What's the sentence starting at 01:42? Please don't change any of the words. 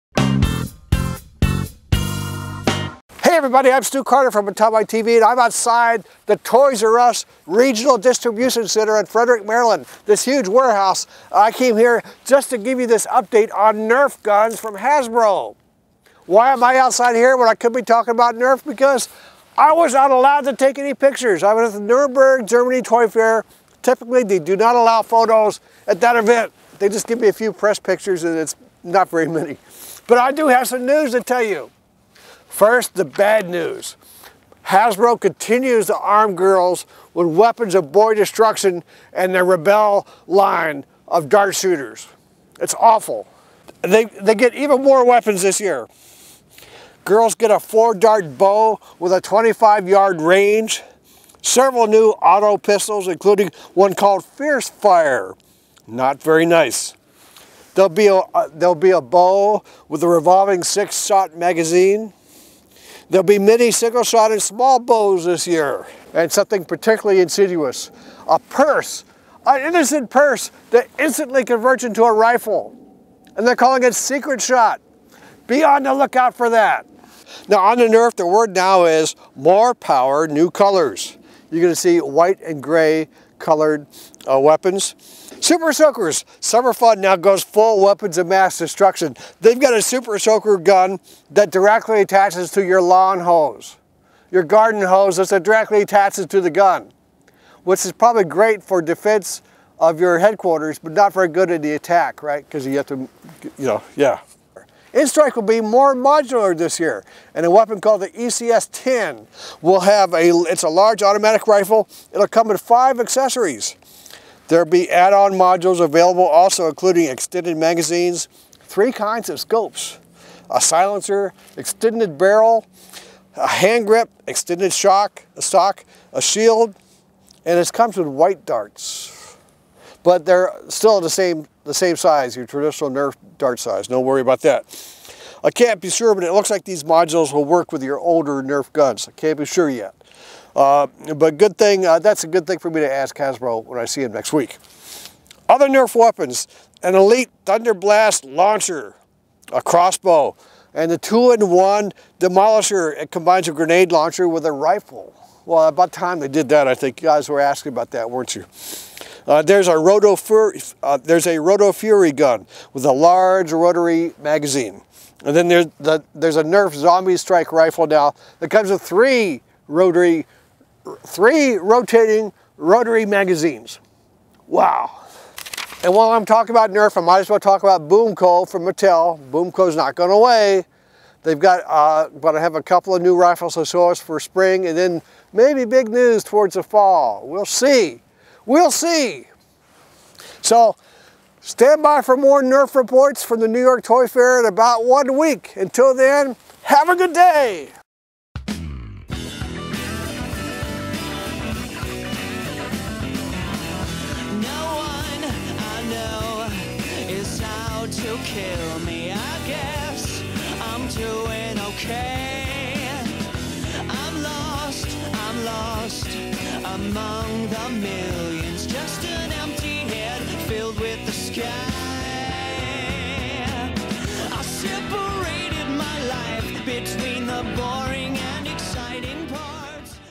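Because you have to, you know, yeah.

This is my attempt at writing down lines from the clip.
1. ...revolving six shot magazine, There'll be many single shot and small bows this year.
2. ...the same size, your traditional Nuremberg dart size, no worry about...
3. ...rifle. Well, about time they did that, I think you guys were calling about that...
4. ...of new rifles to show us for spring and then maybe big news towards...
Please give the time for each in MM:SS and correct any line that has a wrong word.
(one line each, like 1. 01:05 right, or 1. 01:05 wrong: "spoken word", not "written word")
1. 01:00 right
2. 02:11 wrong: "Nerf", not "Nuremberg"
3. 02:34 wrong: "asking", not "calling"
4. 03:02 right.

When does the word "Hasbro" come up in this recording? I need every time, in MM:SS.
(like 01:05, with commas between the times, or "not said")
00:14, 00:34, 02:23.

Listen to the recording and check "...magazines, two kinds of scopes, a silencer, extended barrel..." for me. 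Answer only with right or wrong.
wrong.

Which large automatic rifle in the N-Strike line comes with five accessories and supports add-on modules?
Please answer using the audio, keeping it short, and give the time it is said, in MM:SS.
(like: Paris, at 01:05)
ECS-10, at 01:48.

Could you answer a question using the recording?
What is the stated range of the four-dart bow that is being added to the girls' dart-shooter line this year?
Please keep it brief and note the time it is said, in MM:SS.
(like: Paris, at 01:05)
25 yards, at 00:49.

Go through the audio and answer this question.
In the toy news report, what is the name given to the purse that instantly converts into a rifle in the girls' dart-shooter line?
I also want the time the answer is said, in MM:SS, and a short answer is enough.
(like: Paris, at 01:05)
Secret Shot, at 01:13.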